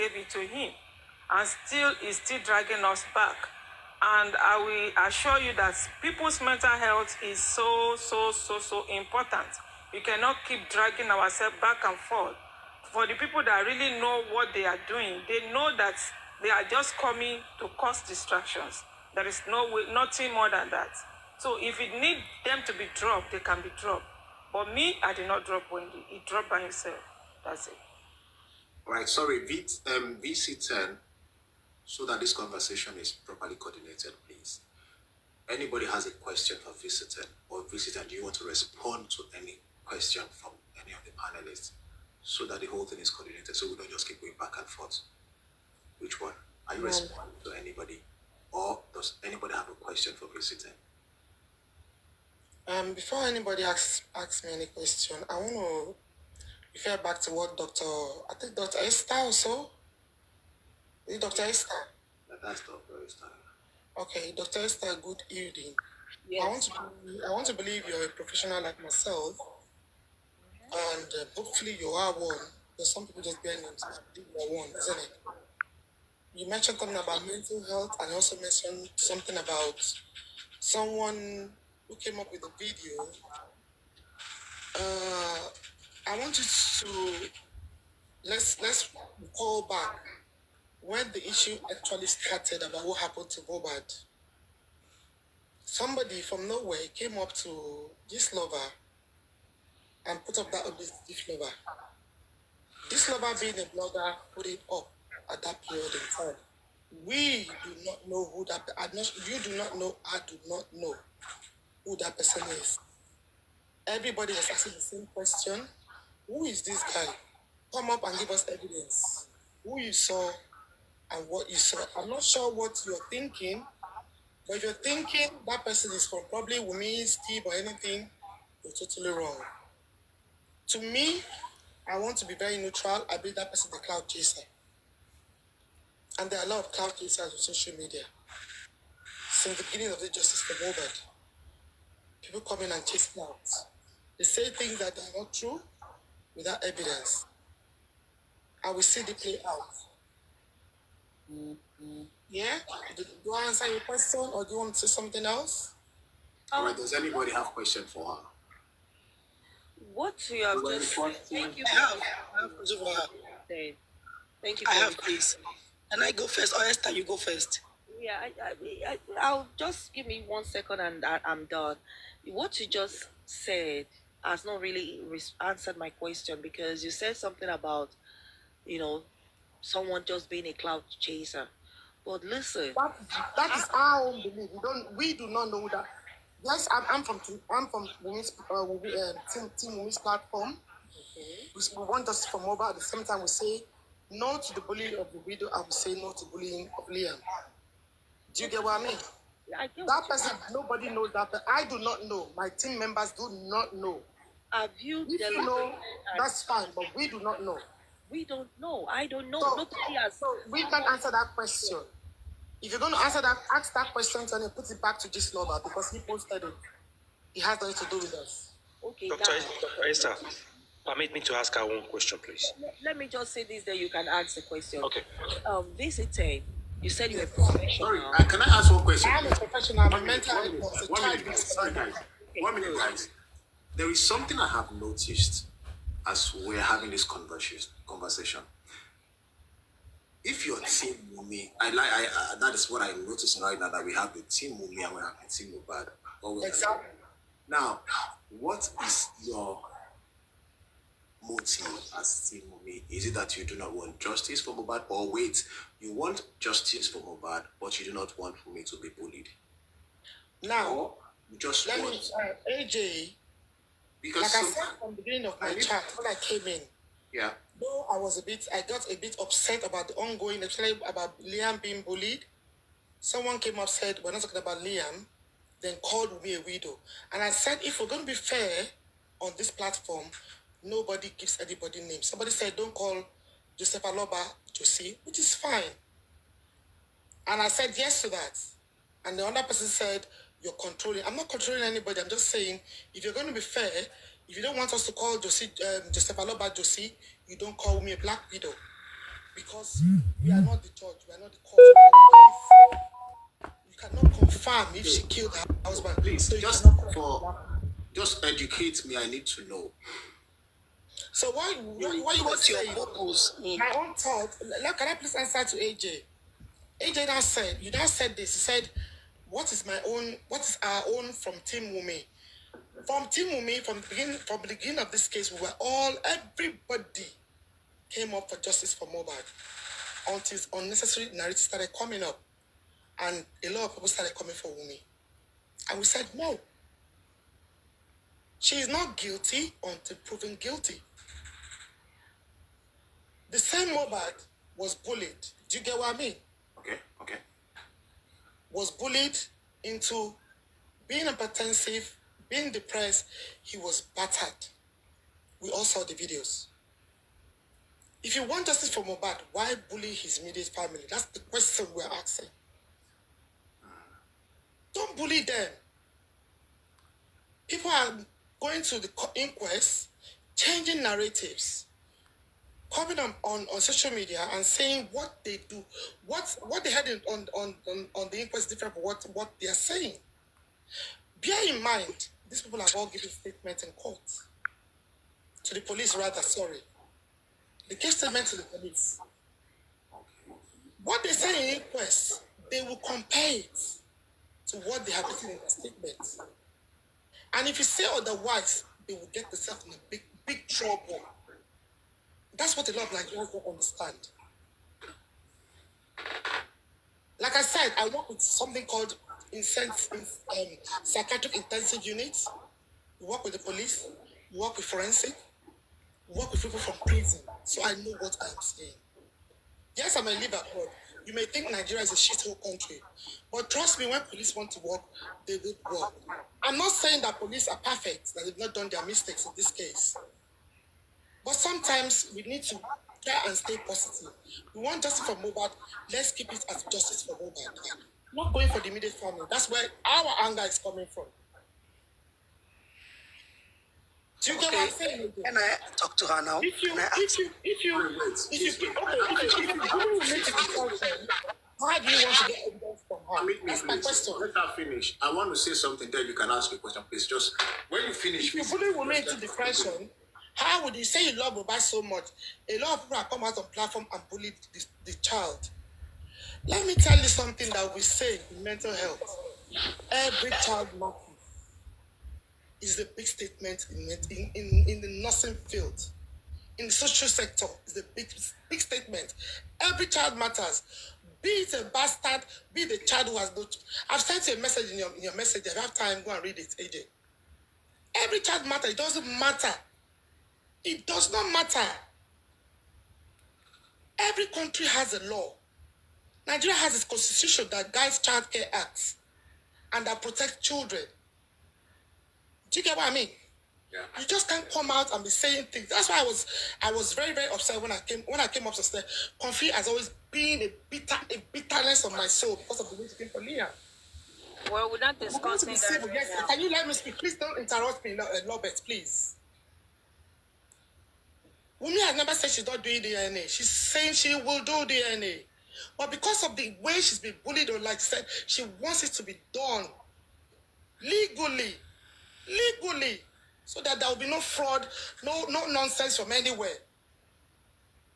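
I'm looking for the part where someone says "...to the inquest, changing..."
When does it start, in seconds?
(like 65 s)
368 s.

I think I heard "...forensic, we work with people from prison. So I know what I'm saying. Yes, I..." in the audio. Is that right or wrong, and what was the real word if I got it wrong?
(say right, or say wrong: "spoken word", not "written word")
right.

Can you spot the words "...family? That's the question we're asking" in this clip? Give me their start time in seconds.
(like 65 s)
360 s.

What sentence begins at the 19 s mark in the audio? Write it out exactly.
There is no way, nothing more than that.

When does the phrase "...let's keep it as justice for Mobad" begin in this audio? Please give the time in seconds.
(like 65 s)
435 s.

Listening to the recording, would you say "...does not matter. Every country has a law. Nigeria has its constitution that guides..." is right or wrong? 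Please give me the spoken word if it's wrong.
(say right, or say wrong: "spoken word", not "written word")
right.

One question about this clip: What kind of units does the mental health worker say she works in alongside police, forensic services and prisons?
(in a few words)
Psychiatric intensive units.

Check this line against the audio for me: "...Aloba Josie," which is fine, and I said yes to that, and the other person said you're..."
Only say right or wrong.
right.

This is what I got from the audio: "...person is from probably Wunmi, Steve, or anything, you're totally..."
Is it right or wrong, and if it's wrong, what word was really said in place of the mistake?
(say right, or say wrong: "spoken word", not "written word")
right.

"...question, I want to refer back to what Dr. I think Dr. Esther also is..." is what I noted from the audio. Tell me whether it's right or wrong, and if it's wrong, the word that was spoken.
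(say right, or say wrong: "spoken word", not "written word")
right.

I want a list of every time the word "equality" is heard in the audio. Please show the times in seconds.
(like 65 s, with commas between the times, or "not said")
not said.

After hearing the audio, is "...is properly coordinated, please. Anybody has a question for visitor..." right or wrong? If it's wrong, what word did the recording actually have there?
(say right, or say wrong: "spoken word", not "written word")
right.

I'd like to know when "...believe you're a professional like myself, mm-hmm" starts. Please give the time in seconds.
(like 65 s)
67 s.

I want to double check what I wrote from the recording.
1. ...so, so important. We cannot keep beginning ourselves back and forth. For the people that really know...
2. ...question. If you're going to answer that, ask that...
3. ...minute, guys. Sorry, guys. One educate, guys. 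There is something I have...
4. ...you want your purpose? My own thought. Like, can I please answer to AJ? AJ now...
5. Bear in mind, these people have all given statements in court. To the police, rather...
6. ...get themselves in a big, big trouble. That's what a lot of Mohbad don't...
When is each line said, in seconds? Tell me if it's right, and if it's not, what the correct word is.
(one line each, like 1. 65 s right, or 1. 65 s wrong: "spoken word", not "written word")
1. 8 s wrong: "dragging", not "beginning"
2. 211 s right
3. 231 s wrong: "minute", not "educate"
4. 312 s right
5. 381 s right
6. 399 s wrong: "Nigerians", not "Mohbad".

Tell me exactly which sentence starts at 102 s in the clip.
This lover being a blogger put it up at that period in time.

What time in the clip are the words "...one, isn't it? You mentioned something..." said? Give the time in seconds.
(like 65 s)
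74 s.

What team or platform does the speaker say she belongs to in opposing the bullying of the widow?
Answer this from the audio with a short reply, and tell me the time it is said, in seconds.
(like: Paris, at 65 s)
Team women's platform, at 189 s.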